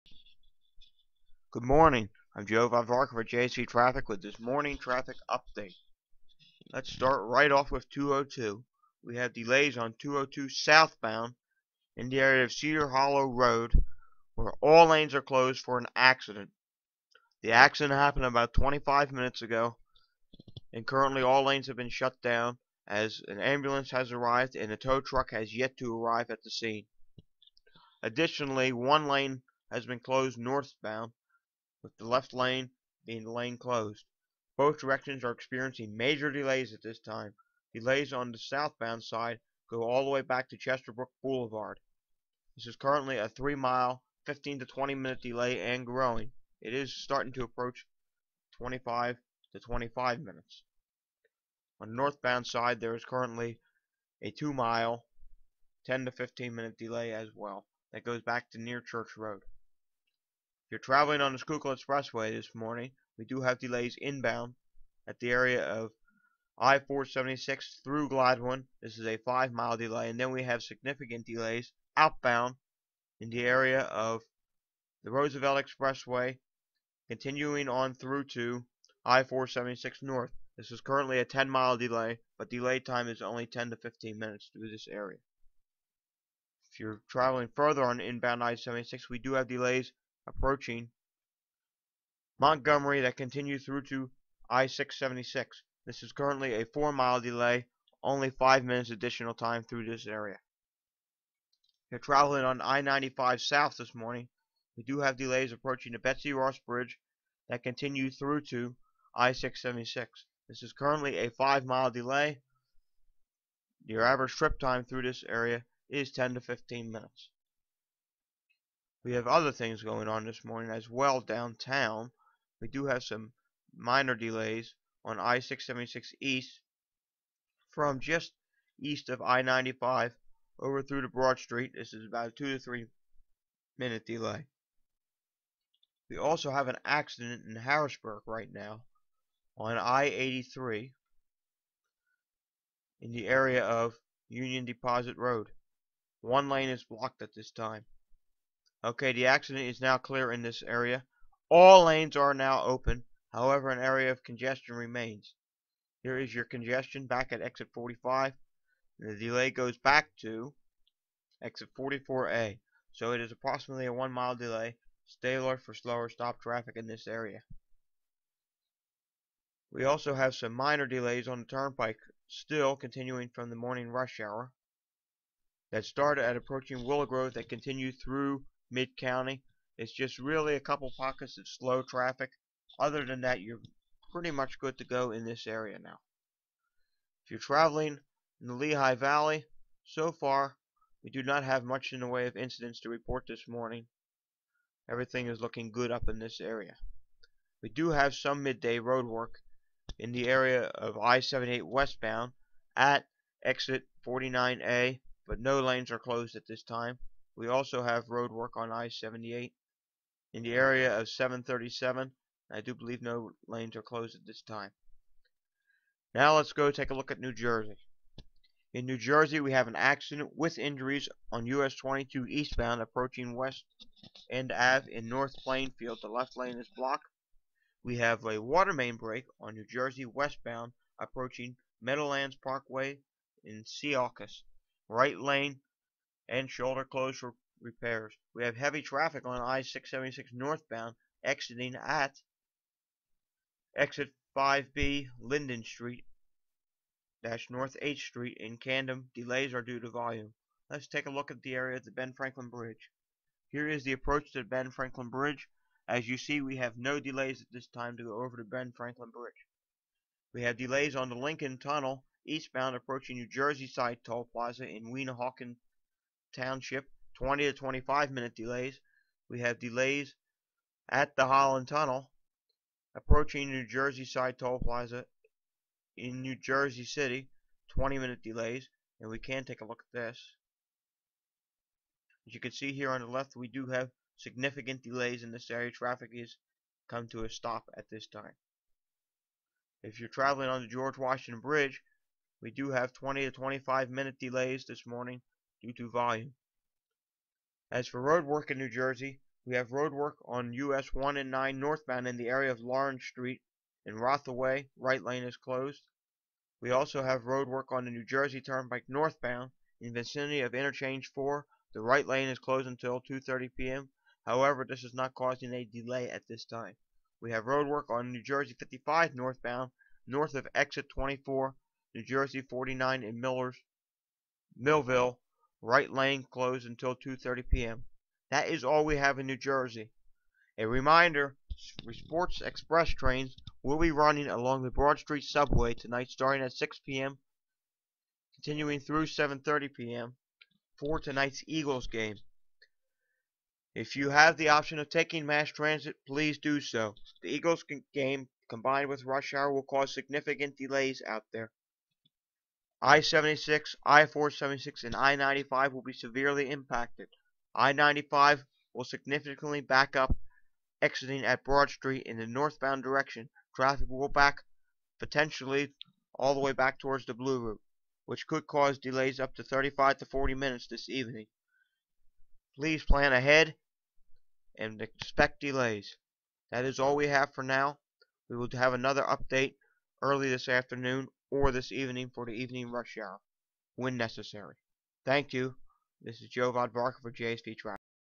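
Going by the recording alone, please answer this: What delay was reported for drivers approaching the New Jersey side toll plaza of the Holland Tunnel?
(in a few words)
20 minutes.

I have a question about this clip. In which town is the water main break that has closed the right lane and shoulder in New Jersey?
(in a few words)
Secaucus.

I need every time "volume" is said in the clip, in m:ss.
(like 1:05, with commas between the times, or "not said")
4:09, 4:55.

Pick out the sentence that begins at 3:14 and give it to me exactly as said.
Everything is looking good up in this area.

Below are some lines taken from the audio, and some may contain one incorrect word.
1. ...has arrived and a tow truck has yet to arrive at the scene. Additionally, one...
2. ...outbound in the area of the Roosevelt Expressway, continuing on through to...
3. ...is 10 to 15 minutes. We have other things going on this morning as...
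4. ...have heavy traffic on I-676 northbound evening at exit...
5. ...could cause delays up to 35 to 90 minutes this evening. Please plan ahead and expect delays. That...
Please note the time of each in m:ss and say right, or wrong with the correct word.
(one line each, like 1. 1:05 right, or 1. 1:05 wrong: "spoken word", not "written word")
1. 0:23 right
2. 1:11 right
3. 1:55 right
4. 3:58 wrong: "exiting", not "evening"
5. 6:08 wrong: "40", not "90".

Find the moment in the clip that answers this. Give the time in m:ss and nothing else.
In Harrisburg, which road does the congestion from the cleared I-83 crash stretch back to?
2:41.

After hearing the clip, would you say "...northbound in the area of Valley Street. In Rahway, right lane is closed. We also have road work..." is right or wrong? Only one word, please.
wrong.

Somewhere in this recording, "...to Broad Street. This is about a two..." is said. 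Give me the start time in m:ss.
2:11.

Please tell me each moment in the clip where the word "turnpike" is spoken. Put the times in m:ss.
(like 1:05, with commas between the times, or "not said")
2:51, 5:08.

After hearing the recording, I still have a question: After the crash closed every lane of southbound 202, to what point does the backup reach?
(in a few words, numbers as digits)
Chesterbrook Boulevard.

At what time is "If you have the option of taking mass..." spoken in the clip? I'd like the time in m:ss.
5:43.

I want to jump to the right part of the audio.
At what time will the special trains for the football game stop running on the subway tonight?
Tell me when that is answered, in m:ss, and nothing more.
5:39.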